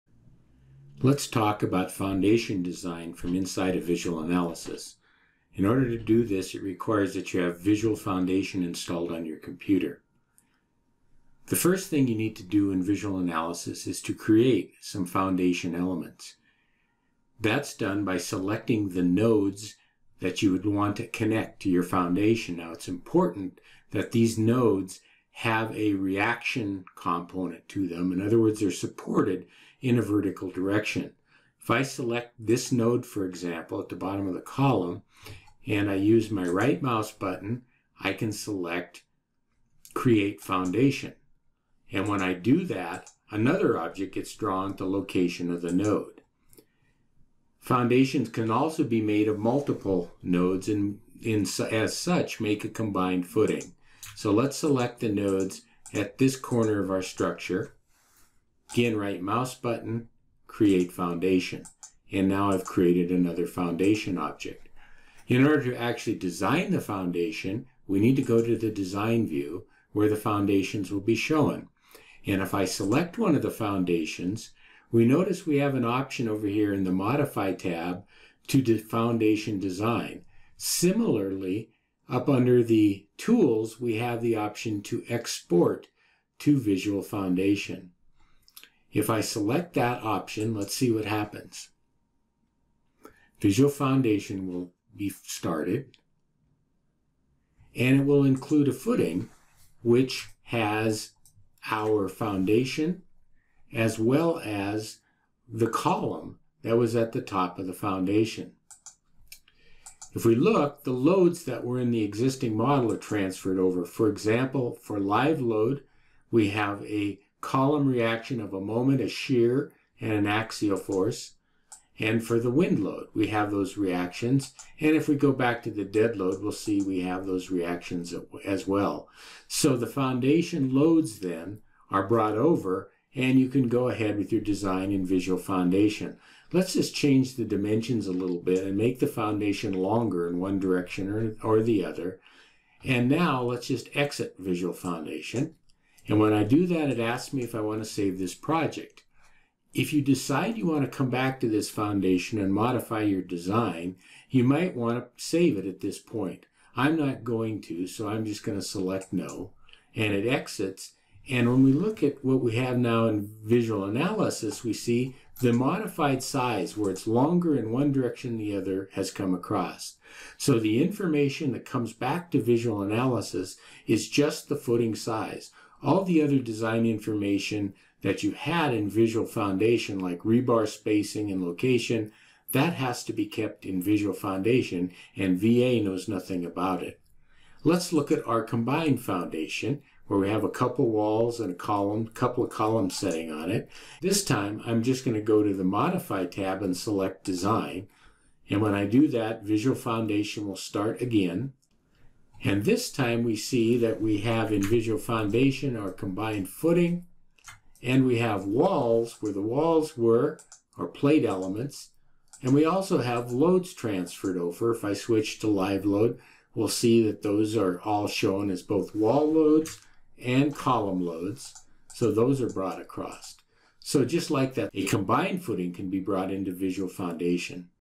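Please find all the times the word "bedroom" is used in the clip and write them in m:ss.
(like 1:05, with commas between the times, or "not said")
not said.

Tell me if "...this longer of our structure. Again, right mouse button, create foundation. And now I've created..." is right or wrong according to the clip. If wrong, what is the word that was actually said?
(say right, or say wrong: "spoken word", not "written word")
wrong: "corner", not "longer".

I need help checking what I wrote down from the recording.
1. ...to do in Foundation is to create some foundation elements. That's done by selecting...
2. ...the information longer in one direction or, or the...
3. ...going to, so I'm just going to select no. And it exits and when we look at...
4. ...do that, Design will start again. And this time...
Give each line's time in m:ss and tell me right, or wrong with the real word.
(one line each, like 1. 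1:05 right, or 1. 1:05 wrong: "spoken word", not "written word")
1. 0:12 wrong: "VisualAnalysis", not "Foundation"
2. 2:18 wrong: "foundation", not "information"
3. 2:37 right
4. 3:18 wrong: "VisualFoundation", not "Design".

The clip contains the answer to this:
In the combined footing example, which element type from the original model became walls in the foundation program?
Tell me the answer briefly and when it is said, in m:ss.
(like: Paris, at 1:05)
plate elements, at 3:30.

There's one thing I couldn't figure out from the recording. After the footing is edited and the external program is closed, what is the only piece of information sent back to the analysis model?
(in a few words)
footing size.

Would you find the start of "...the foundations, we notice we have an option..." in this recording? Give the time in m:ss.
1:13.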